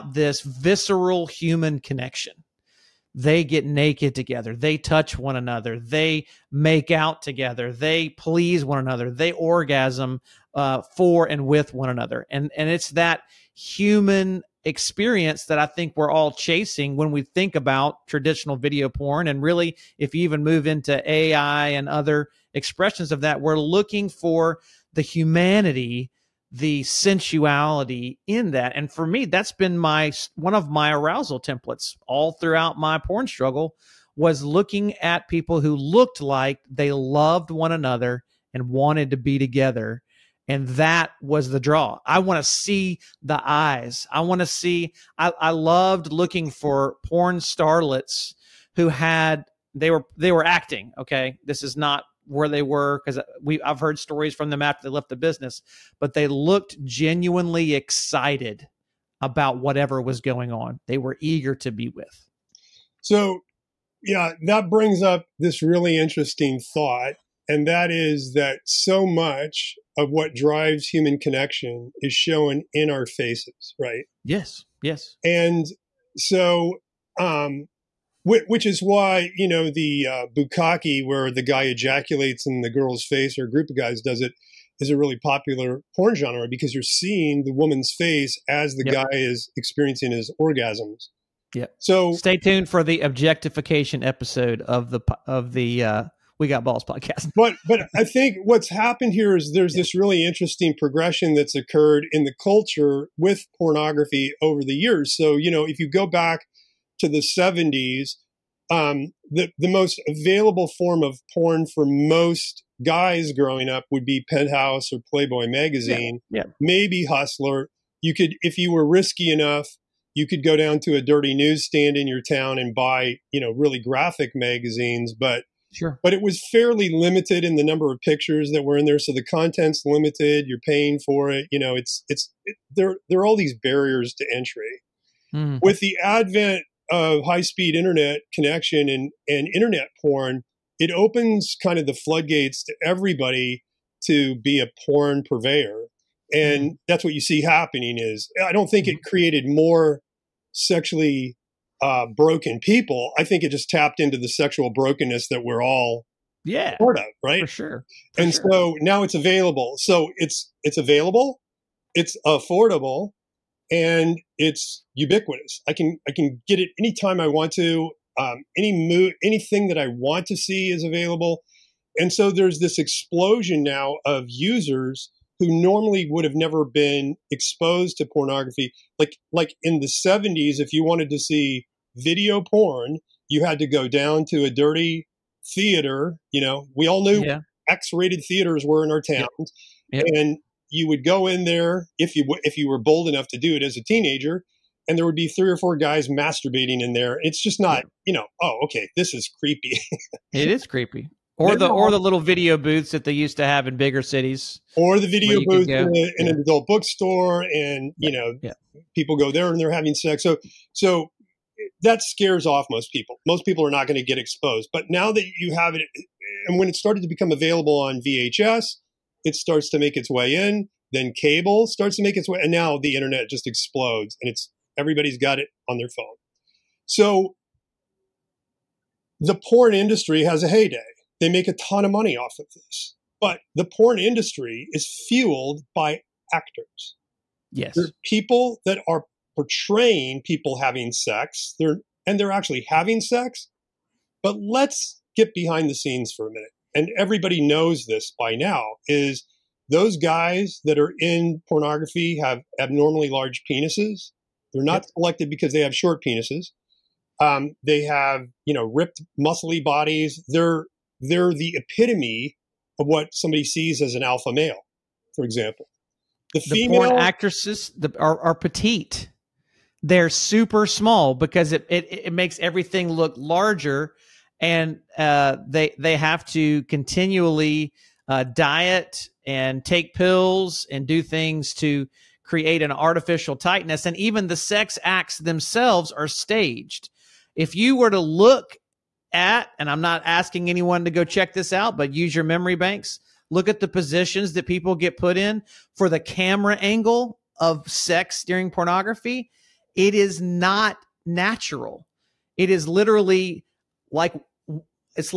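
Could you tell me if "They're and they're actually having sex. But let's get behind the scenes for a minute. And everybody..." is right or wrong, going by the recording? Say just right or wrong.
right.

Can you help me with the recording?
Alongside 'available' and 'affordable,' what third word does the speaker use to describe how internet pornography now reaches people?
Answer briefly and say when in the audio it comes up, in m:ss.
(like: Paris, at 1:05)
Ubiquitous, at 2:44.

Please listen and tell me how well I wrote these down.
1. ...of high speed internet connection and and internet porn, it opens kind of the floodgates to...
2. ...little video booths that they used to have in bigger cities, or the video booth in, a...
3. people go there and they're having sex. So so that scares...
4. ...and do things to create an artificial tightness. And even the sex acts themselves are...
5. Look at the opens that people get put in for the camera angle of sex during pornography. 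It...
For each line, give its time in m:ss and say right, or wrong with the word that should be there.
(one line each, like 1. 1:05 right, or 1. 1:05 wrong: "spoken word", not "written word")
1. 2:16 right
2. 3:21 right
3. 3:28 right
4. 4:40 right
5. 4:53 wrong: "positions", not "opens".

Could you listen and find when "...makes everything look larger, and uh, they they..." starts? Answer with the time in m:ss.
4:32.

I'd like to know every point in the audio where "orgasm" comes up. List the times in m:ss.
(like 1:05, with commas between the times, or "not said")
0:09, 1:30.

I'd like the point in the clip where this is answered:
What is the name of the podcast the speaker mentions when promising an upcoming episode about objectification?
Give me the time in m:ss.
1:36.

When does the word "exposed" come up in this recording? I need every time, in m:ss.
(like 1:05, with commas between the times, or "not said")
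2:57, 3:34.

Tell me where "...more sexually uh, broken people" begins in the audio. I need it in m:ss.
2:29.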